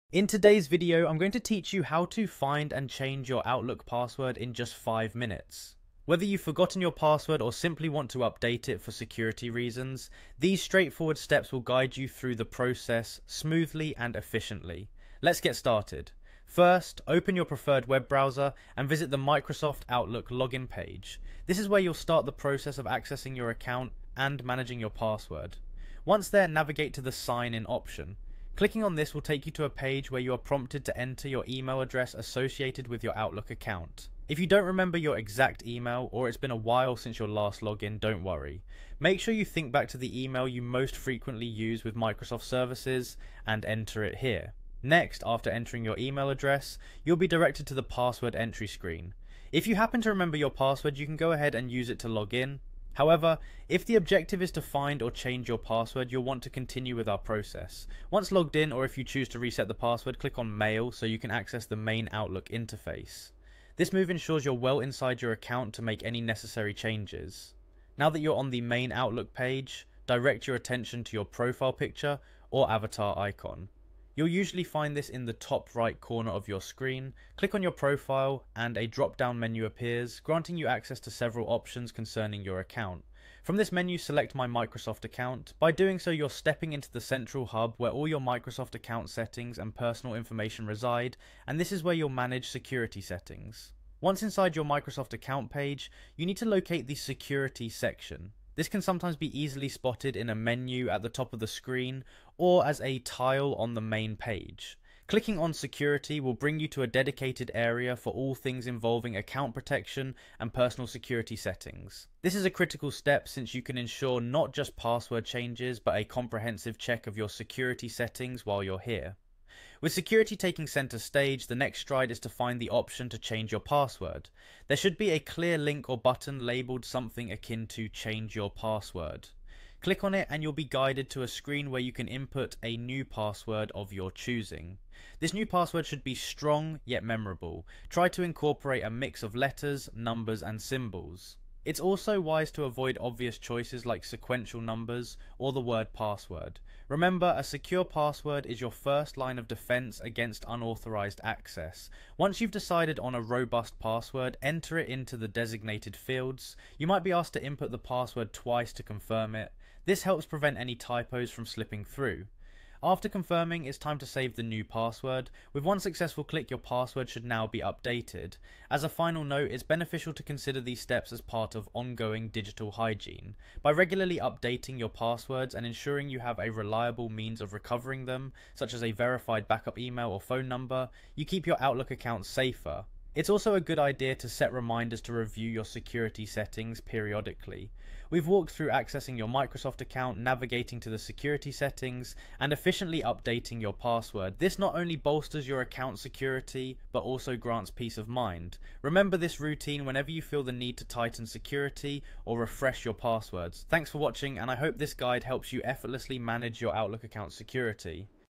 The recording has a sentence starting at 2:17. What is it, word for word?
Try to incorporate a mix of letters, numbers and symbols.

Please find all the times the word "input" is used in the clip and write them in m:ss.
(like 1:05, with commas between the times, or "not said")
2:12, 2:37.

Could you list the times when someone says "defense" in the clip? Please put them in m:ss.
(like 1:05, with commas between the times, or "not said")
2:29.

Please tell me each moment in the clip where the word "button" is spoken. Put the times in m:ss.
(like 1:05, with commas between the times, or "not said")
2:05.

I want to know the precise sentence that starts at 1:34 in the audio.
Once inside your Microsoft account page, you need to locate the security section.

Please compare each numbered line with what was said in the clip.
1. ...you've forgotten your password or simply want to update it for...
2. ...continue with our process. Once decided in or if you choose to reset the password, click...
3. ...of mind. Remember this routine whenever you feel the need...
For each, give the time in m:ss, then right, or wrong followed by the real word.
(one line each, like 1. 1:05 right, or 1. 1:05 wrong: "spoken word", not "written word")
1. 0:06 right
2. 0:56 wrong: "logged", not "decided"
3. 3:17 right.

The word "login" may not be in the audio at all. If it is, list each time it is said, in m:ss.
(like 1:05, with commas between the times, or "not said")
0:20, 0:37.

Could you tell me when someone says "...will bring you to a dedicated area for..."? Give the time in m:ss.
1:46.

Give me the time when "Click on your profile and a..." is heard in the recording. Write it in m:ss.
1:17.